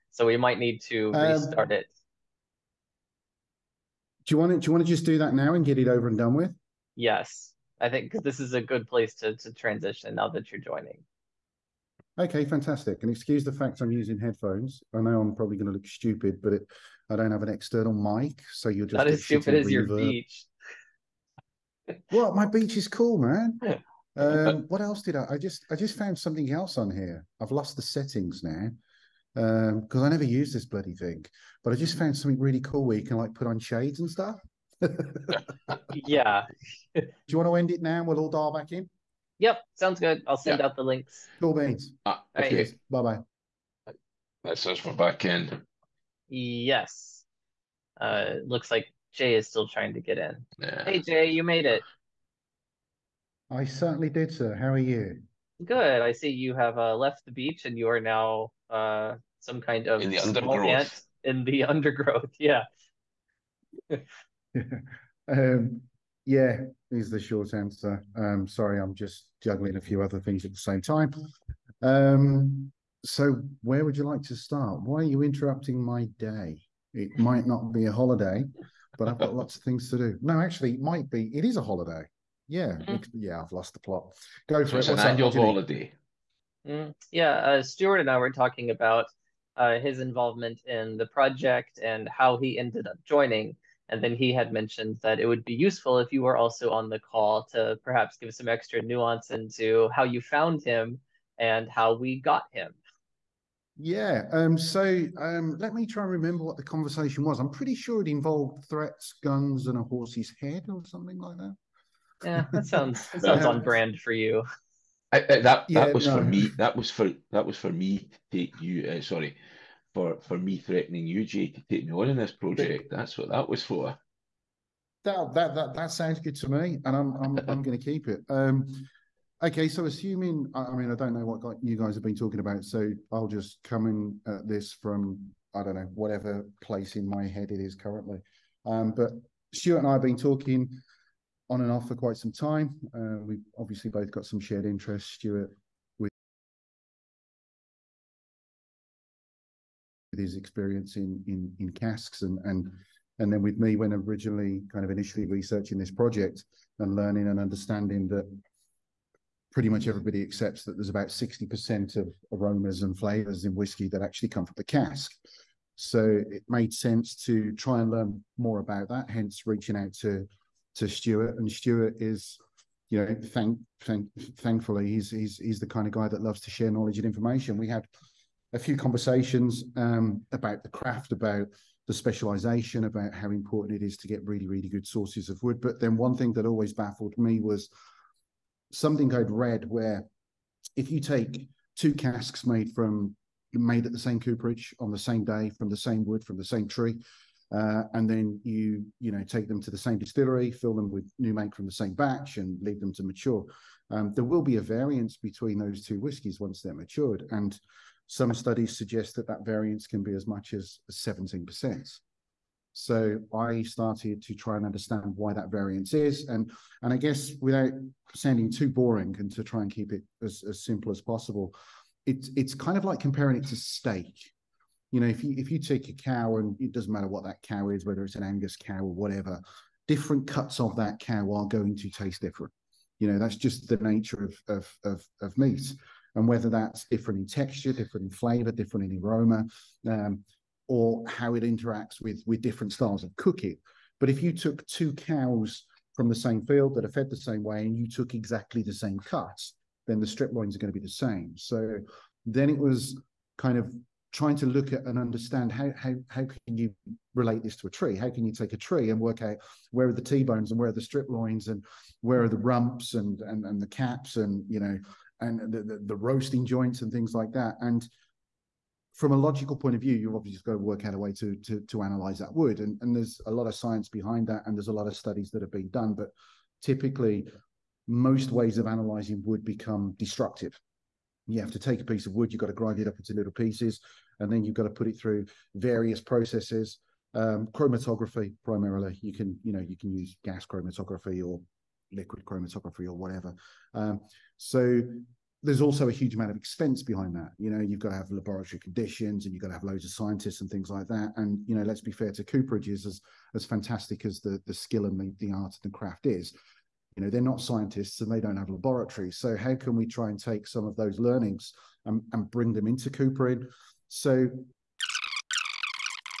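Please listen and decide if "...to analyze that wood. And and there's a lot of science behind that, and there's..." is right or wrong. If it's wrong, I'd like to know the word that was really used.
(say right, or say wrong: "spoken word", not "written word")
right.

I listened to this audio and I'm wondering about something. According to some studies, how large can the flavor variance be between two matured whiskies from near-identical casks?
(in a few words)
17%.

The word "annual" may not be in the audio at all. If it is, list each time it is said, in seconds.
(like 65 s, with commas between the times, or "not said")
84 s.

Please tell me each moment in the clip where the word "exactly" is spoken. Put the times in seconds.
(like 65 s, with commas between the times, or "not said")
248 s.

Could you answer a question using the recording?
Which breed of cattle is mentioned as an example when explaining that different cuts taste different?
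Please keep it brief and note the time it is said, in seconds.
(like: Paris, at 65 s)
Angus, at 228 s.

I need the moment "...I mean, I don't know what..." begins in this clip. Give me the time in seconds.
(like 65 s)
130 s.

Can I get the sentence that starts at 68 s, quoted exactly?
Um, sorry, I'm just juggling a few other things at the same time.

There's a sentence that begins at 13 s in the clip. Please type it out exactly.
And excuse the fact I'm using headphones.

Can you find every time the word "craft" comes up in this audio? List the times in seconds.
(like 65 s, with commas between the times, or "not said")
180 s, 305 s.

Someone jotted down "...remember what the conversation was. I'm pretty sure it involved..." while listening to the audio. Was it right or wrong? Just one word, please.
right.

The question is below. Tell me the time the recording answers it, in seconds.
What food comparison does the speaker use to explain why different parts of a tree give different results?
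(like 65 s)
223 s.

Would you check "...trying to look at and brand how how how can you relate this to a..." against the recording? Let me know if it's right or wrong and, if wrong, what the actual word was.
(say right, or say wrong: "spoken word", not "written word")
wrong: "understand", not "brand".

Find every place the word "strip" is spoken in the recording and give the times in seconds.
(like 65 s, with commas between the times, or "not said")
250 s, 260 s.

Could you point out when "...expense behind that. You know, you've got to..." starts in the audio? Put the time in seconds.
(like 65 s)
296 s.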